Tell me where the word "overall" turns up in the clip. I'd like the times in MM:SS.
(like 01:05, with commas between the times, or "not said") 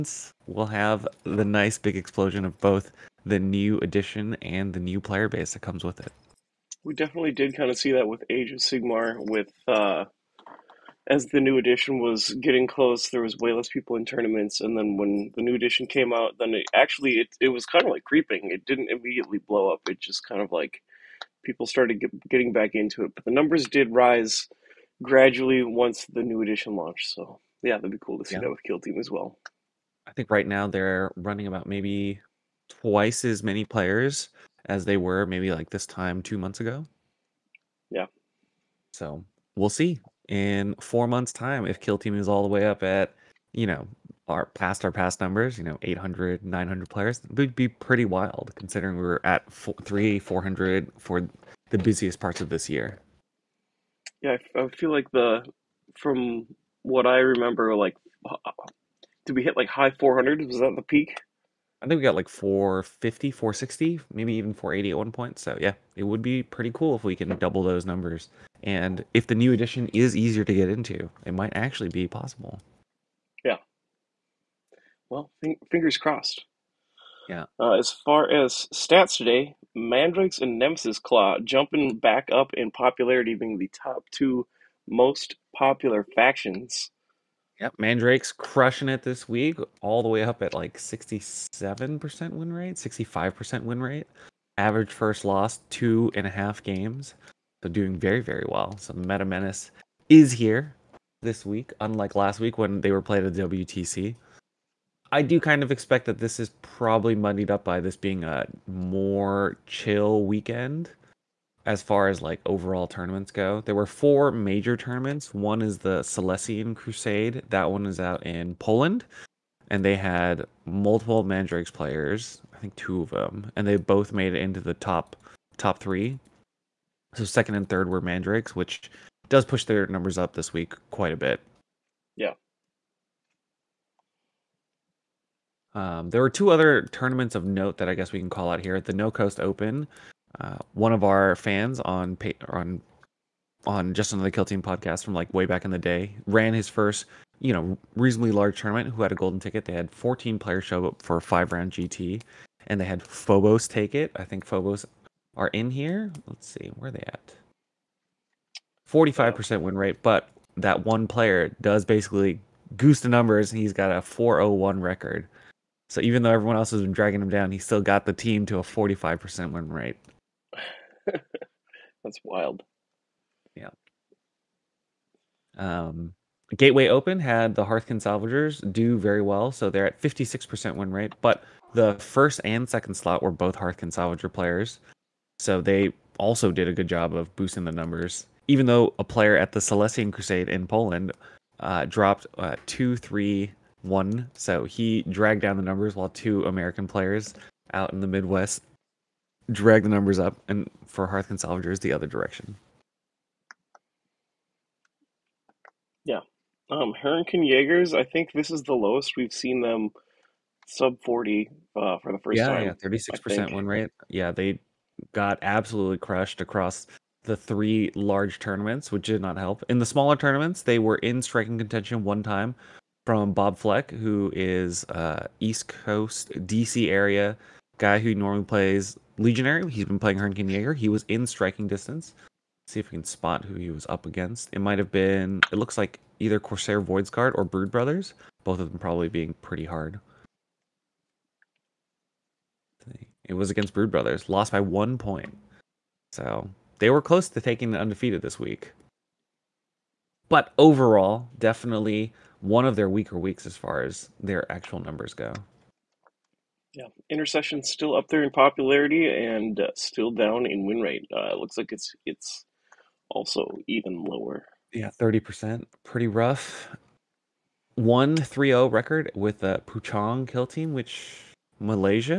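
01:52, 04:10.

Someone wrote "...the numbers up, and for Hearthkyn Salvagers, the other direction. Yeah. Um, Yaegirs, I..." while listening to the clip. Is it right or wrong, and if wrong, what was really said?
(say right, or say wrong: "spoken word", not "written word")
right.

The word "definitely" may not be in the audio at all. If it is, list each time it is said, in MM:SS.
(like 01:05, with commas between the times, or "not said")
00:06, 04:11.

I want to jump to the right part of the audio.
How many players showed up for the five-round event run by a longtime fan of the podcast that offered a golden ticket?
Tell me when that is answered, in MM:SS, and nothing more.
02:29.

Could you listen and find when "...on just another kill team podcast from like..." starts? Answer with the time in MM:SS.
02:23.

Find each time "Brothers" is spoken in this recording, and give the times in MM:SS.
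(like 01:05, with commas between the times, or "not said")
03:57, 04:03.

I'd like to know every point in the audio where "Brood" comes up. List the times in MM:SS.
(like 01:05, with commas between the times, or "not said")
03:57, 04:03.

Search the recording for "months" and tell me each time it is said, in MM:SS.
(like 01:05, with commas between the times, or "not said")
00:36, 00:41.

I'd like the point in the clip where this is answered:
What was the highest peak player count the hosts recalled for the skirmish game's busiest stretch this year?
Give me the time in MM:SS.
01:04.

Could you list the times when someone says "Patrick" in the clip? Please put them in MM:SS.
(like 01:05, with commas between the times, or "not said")
not said.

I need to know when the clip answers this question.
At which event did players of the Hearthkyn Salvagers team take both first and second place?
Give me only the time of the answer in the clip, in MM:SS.
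02:56.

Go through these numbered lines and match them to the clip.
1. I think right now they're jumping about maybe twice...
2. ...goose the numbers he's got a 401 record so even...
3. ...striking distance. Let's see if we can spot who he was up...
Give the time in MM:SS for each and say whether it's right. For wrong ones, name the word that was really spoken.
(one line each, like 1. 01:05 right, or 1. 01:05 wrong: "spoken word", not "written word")
1. 00:30 wrong: "running", not "jumping"
2. 02:42 right
3. 03:51 right.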